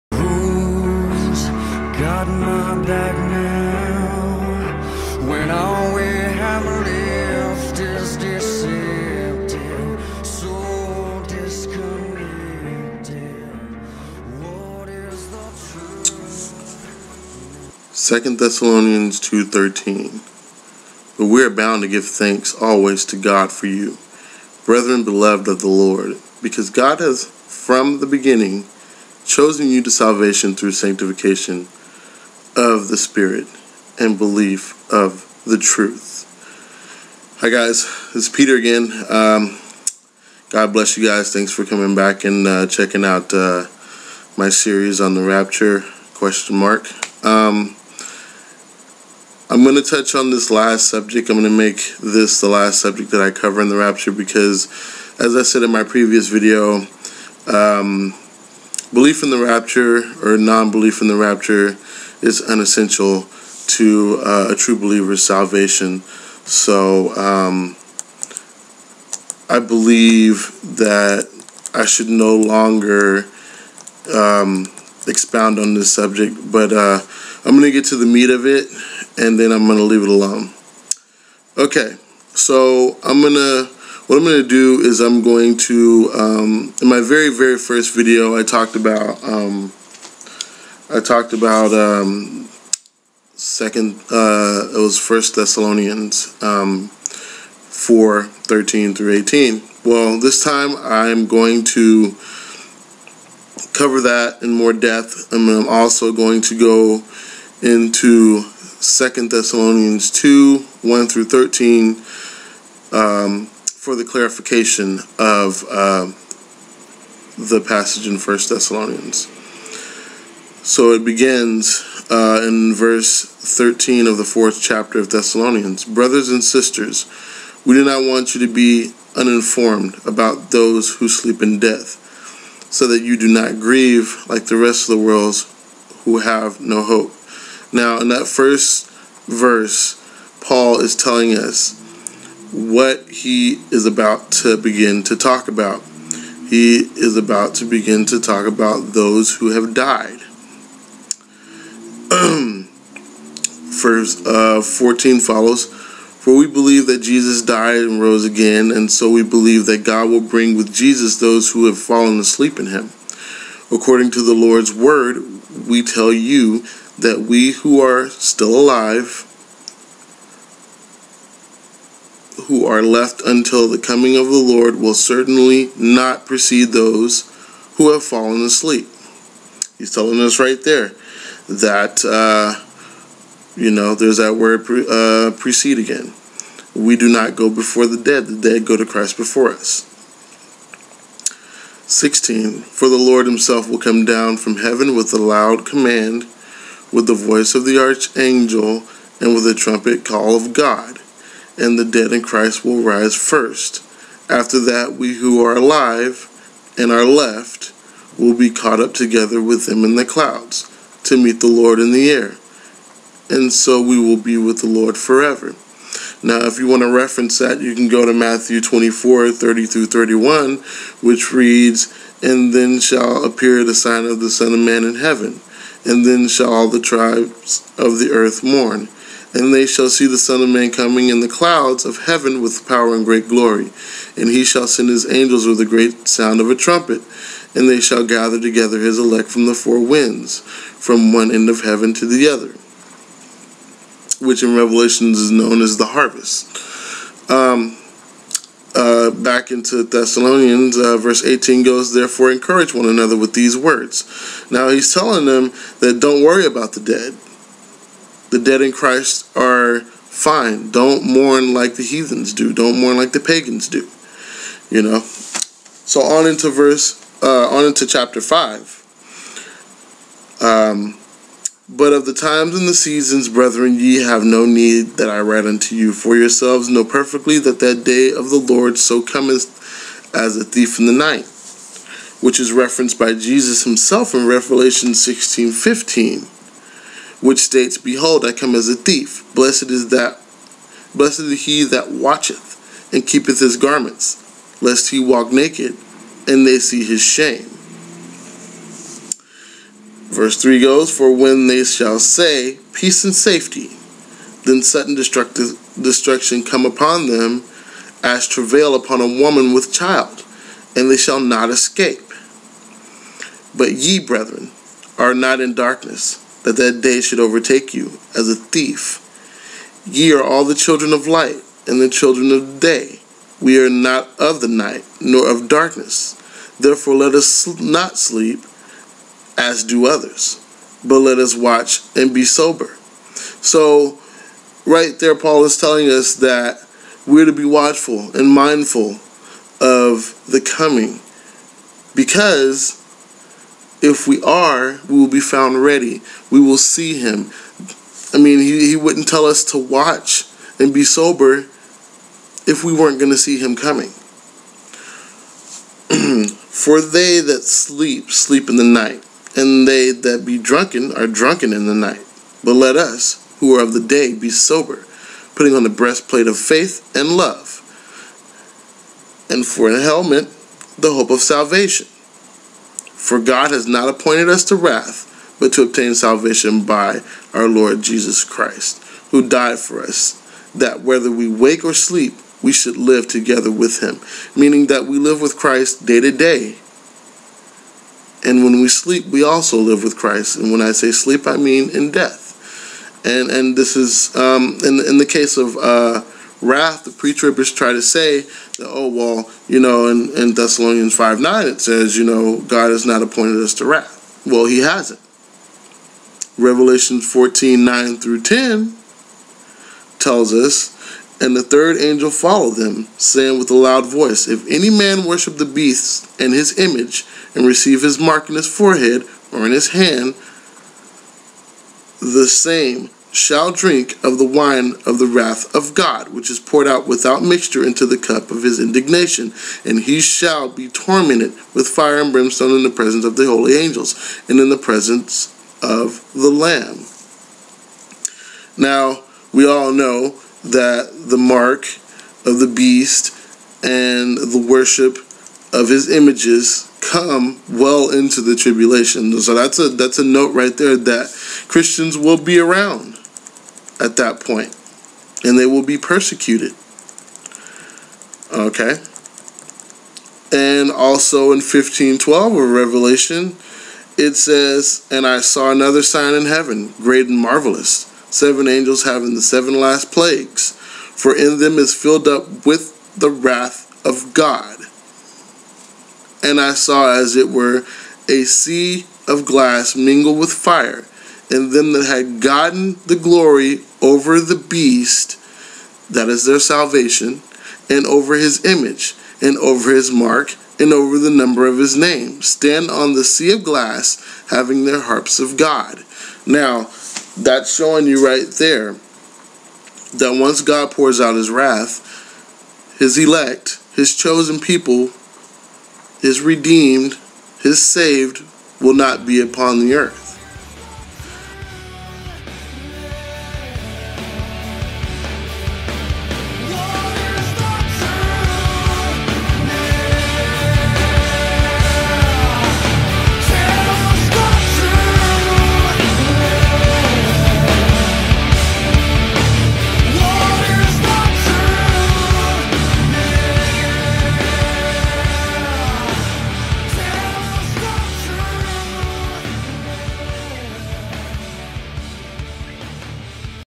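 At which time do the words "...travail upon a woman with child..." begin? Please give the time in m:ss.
5:08.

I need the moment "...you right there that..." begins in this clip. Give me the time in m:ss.
8:17.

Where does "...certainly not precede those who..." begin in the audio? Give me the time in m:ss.
2:54.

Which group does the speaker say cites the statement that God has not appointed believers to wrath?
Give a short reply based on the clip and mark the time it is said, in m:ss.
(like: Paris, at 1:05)
pre-tribbers, at 6:36.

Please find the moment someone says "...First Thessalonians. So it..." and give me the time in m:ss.
1:58.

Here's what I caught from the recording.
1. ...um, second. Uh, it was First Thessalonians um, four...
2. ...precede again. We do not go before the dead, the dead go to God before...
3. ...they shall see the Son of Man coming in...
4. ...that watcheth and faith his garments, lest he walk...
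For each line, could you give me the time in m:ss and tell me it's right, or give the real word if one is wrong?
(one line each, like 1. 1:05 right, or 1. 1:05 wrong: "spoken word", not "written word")
1. 1:31 right
2. 3:05 wrong: "Christ", not "God"
3. 3:49 right
4. 4:51 wrong: "keepeth", not "faith".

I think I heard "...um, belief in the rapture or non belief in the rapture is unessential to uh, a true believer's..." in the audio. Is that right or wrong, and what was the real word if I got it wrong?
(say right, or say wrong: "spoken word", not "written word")
right.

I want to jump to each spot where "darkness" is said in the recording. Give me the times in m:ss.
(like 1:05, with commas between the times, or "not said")
5:15, 5:25.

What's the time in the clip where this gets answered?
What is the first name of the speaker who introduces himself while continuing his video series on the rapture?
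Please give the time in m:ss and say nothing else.
0:38.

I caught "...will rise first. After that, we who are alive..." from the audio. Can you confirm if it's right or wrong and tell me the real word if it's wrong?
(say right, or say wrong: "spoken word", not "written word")
right.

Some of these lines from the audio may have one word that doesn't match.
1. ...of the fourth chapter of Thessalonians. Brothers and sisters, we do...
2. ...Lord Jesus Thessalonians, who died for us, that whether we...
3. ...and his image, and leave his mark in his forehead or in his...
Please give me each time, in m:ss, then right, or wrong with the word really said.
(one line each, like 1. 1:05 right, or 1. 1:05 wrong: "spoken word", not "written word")
1. 2:04 right
2. 6:17 wrong: "Christ", not "Thessalonians"
3. 6:56 wrong: "receive", not "leave".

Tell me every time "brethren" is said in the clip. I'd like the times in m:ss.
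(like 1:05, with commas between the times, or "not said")
0:24, 4:33, 5:14.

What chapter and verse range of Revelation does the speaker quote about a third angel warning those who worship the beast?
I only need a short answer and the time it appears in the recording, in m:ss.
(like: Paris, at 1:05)
Revelation 14:9-10, at 6:46.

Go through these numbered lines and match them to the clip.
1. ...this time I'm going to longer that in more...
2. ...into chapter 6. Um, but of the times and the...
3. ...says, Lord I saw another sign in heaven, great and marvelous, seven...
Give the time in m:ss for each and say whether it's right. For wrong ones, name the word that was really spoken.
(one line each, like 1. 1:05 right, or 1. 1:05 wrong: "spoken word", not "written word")
1. 1:40 wrong: "cover", not "longer"
2. 4:27 wrong: "5", not "6"
3. 7:44 wrong: "And", not "Lord".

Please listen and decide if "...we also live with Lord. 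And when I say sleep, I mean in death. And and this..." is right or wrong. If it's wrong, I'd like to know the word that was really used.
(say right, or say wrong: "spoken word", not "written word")
wrong: "Christ", not "Lord".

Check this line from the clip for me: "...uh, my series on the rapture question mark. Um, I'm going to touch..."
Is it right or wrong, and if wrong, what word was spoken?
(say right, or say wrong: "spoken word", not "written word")
right.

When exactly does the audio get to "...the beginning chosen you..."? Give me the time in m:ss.
0:27.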